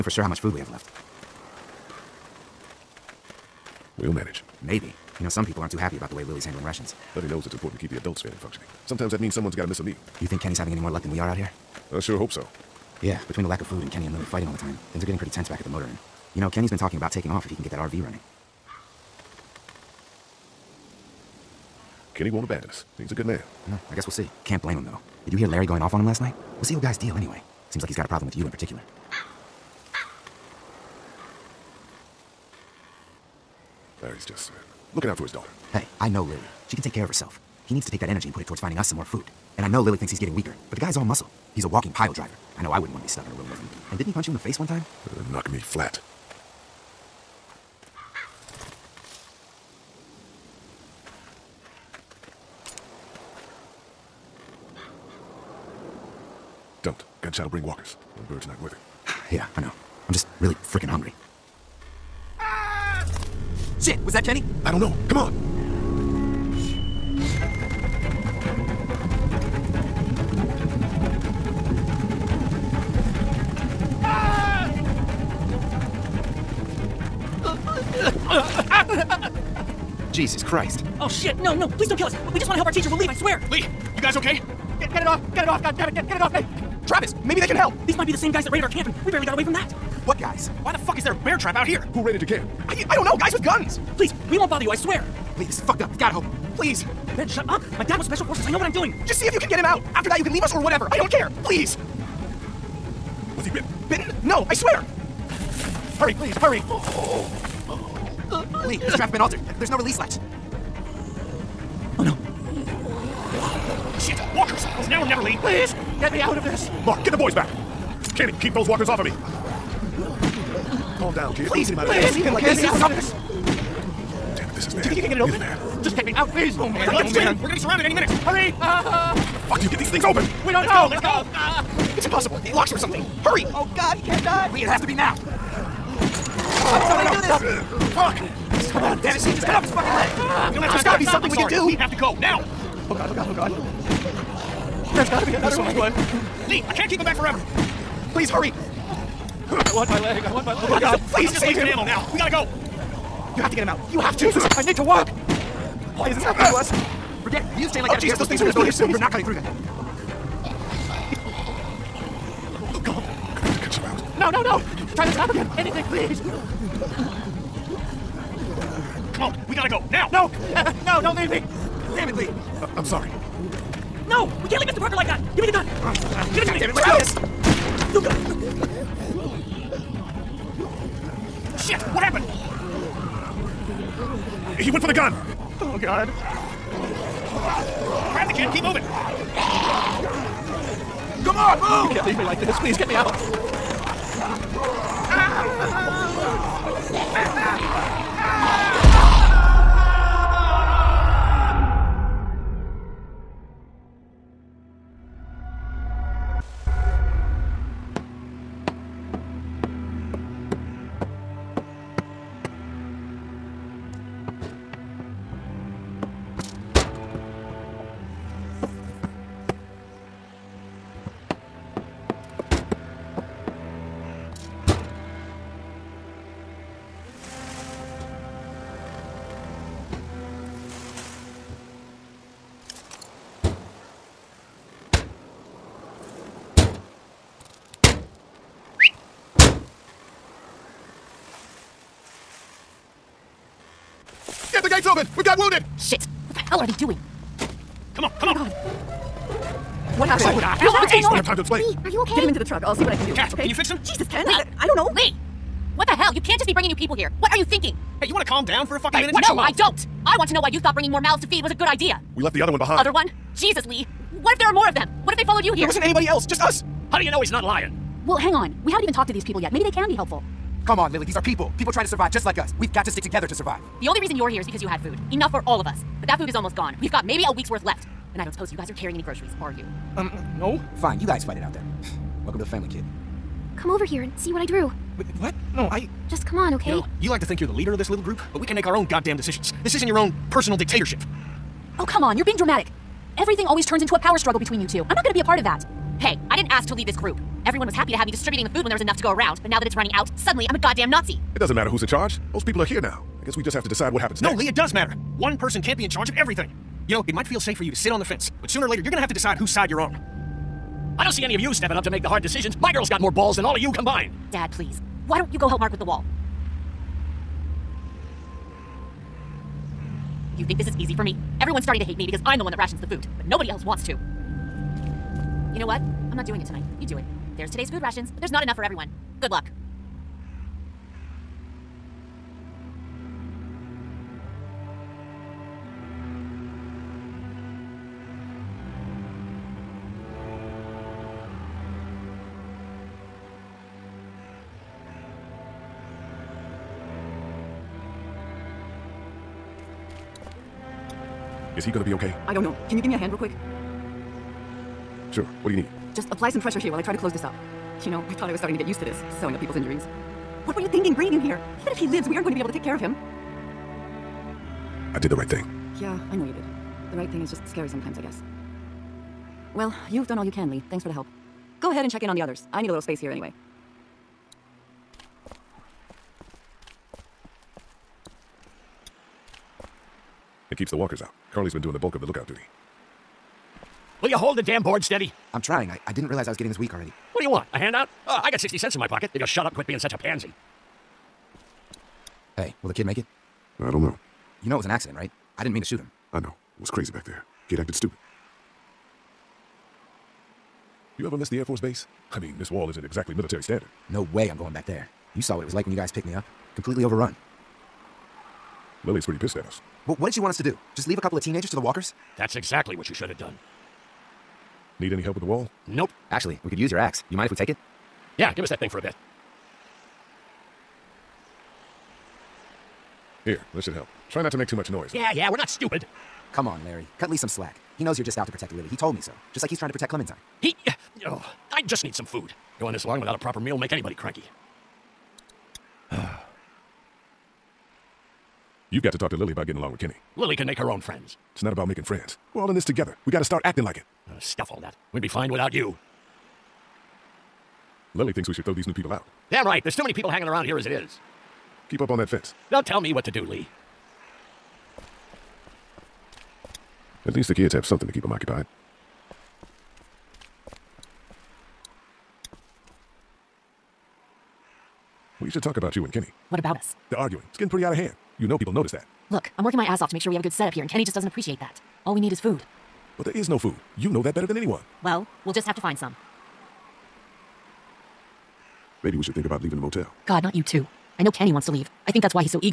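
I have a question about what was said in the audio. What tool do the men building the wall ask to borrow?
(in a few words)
axe.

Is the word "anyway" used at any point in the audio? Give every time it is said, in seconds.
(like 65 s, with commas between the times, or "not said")
27 s, 373 s.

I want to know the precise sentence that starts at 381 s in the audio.
Carley's been doing the bulk of the lookout duty.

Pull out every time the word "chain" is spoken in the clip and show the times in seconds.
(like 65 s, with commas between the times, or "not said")
157 s.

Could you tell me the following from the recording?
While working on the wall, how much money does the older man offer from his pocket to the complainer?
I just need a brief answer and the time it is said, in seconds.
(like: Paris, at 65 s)
60 cents, at 388 s.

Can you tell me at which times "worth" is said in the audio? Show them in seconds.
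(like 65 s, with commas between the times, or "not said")
58 s, 277 s.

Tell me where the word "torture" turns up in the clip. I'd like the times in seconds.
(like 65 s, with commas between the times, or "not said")
not said.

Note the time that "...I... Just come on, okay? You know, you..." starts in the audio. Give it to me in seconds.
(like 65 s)
285 s.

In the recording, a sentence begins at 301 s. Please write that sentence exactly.
It doesn't matter who's in charge.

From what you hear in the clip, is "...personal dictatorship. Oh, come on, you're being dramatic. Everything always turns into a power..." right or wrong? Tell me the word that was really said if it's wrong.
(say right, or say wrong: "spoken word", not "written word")
right.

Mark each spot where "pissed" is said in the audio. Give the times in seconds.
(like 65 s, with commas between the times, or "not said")
409 s.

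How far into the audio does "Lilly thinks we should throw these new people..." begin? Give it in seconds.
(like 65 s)
447 s.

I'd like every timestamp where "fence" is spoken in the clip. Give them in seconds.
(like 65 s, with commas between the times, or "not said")
308 s, 452 s.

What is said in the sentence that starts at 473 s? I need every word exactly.
You know that better than anyone.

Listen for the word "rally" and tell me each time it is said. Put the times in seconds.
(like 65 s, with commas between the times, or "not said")
not said.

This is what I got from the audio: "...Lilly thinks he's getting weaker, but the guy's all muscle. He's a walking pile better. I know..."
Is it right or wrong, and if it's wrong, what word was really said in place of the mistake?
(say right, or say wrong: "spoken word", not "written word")
wrong: "driver", not "better".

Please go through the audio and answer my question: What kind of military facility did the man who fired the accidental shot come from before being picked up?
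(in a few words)
Air Force Base.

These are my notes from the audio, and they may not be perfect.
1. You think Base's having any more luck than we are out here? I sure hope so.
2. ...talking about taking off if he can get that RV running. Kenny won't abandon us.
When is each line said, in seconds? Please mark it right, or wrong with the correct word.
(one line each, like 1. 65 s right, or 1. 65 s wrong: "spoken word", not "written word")
1. 10 s wrong: "Kenny", not "Base"
2. 16 s right.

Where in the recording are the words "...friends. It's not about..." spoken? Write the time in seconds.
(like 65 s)
440 s.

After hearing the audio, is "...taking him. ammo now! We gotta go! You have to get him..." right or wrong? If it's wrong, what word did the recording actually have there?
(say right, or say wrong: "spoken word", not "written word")
wrong: "wasting", not "taking".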